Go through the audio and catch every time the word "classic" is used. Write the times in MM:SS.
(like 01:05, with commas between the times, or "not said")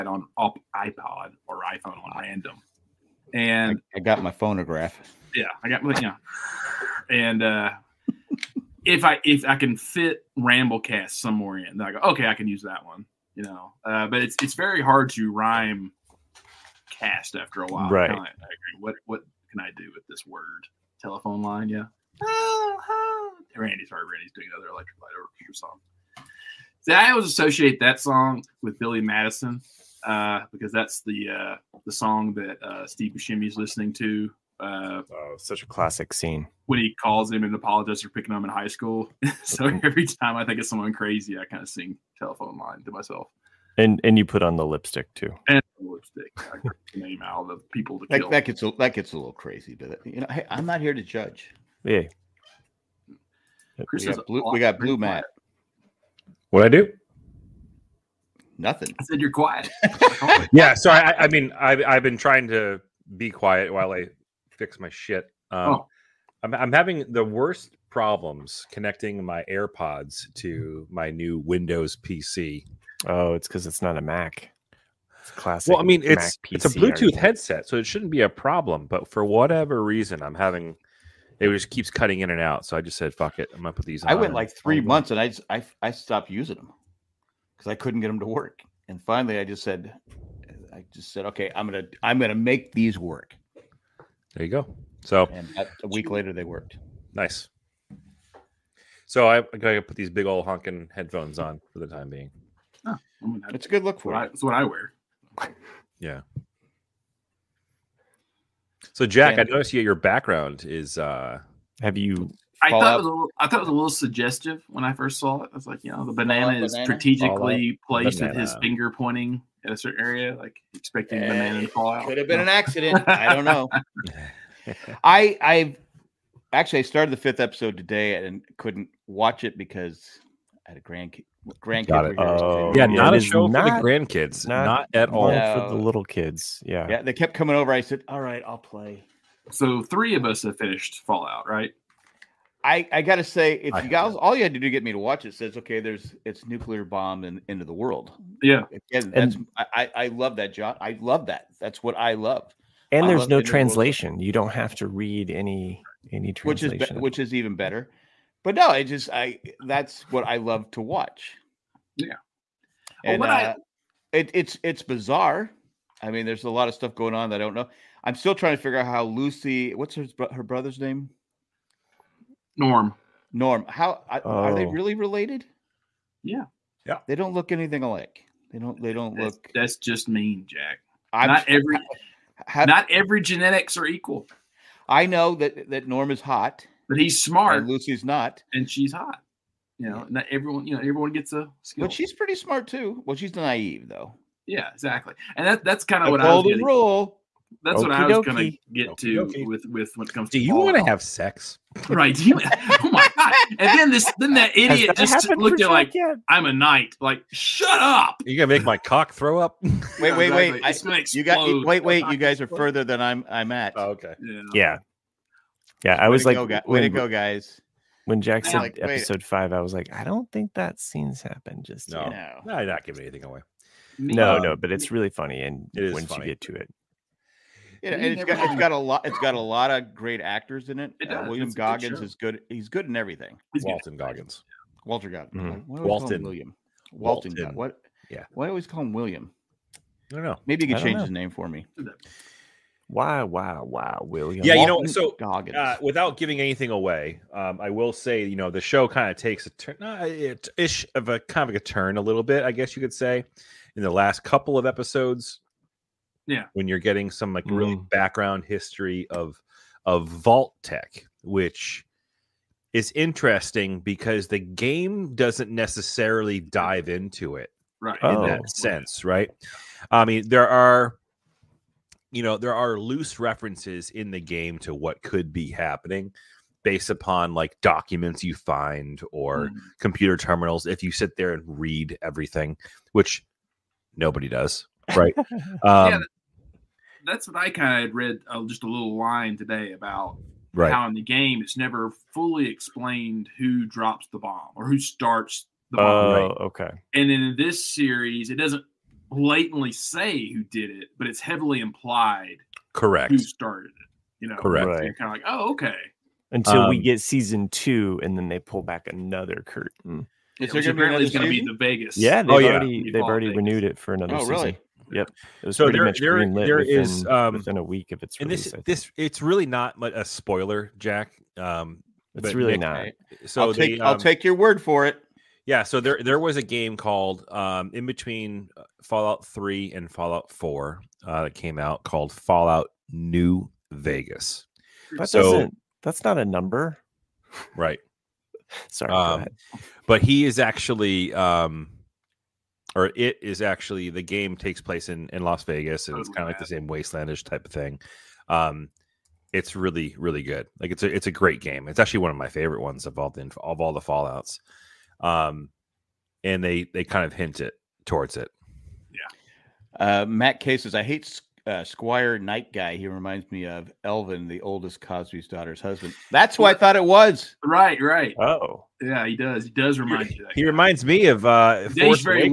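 00:35, 01:15.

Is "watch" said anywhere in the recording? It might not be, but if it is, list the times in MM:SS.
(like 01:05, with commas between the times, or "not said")
02:09, 02:24, 02:40.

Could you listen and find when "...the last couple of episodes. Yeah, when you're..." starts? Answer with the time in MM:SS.
04:13.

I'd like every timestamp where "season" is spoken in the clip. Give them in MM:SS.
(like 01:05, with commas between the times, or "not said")
05:06, 05:14.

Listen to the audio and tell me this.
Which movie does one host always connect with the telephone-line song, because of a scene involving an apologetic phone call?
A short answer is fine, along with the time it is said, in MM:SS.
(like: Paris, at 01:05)
Billy Madison, at 00:28.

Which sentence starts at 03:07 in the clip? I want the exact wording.
And Lucy's not, and she's hot.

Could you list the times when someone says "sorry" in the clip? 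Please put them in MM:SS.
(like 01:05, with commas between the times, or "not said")
00:23, 05:38.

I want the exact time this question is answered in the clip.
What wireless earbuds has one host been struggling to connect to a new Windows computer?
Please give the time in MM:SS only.
01:09.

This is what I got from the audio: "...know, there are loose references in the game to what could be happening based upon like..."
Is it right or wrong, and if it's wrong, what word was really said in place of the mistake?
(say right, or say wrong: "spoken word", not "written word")
right.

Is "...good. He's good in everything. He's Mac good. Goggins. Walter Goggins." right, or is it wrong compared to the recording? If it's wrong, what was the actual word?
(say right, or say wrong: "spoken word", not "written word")
wrong: "Walton", not "Mac".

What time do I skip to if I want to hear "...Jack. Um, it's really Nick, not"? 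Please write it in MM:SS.
05:20.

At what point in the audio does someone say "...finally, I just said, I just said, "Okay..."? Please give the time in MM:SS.
01:29.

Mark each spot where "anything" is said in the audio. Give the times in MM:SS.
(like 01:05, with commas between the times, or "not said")
02:57, 03:43, 04:06.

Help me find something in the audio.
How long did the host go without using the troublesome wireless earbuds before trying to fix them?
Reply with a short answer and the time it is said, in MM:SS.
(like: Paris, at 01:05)
three months, at 01:24.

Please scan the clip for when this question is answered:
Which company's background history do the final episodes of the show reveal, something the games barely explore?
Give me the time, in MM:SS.
04:20.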